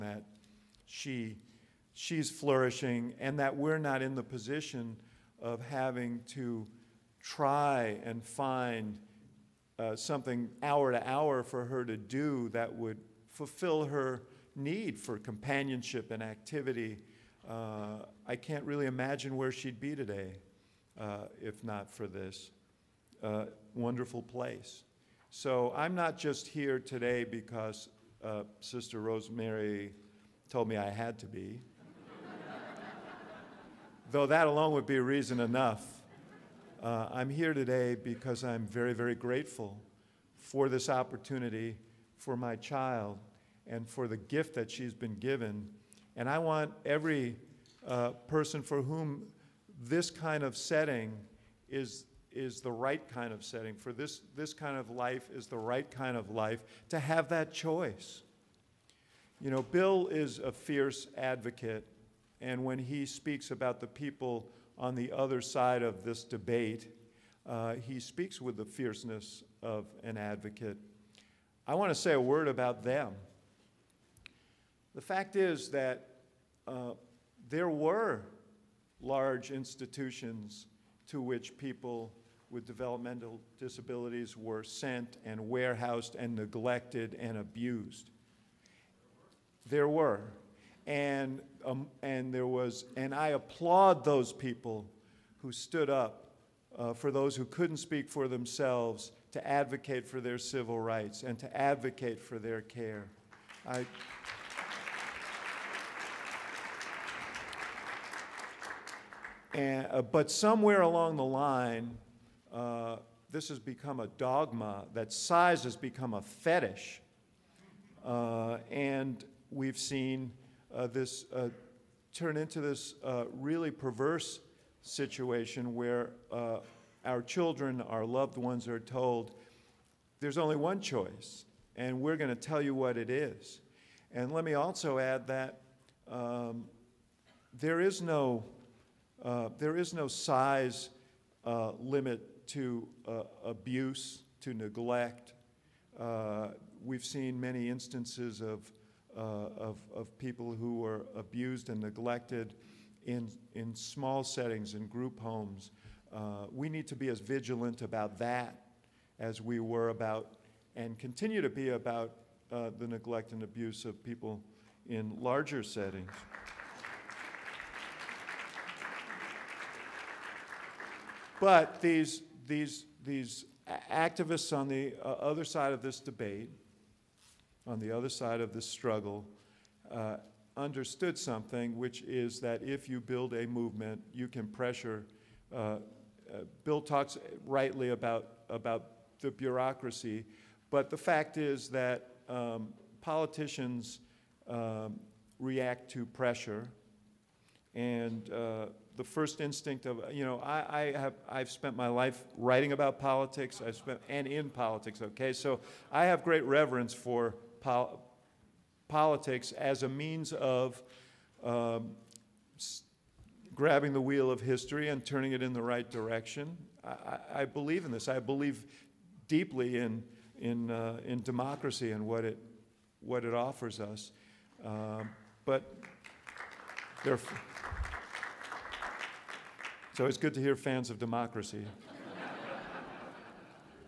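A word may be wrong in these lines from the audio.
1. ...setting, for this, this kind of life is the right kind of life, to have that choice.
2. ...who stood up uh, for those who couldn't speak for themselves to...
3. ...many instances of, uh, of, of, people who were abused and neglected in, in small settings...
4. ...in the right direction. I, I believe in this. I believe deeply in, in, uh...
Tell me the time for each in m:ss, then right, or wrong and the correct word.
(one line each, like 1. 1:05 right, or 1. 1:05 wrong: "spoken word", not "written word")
1. 0:53 right
2. 1:35 right
3. 2:27 right
4. 3:35 right.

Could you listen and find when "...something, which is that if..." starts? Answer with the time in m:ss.
3:01.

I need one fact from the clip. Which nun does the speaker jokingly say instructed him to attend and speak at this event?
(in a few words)
Sister Rosemary.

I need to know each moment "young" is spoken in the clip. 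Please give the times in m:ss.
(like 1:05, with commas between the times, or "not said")
not said.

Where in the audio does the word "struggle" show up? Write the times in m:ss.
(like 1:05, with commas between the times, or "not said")
2:58.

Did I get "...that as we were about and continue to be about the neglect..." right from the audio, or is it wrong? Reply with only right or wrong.
right.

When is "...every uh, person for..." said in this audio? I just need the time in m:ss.
0:46.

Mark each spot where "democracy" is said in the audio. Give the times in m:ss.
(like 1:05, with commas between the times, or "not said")
3:41, 3:50.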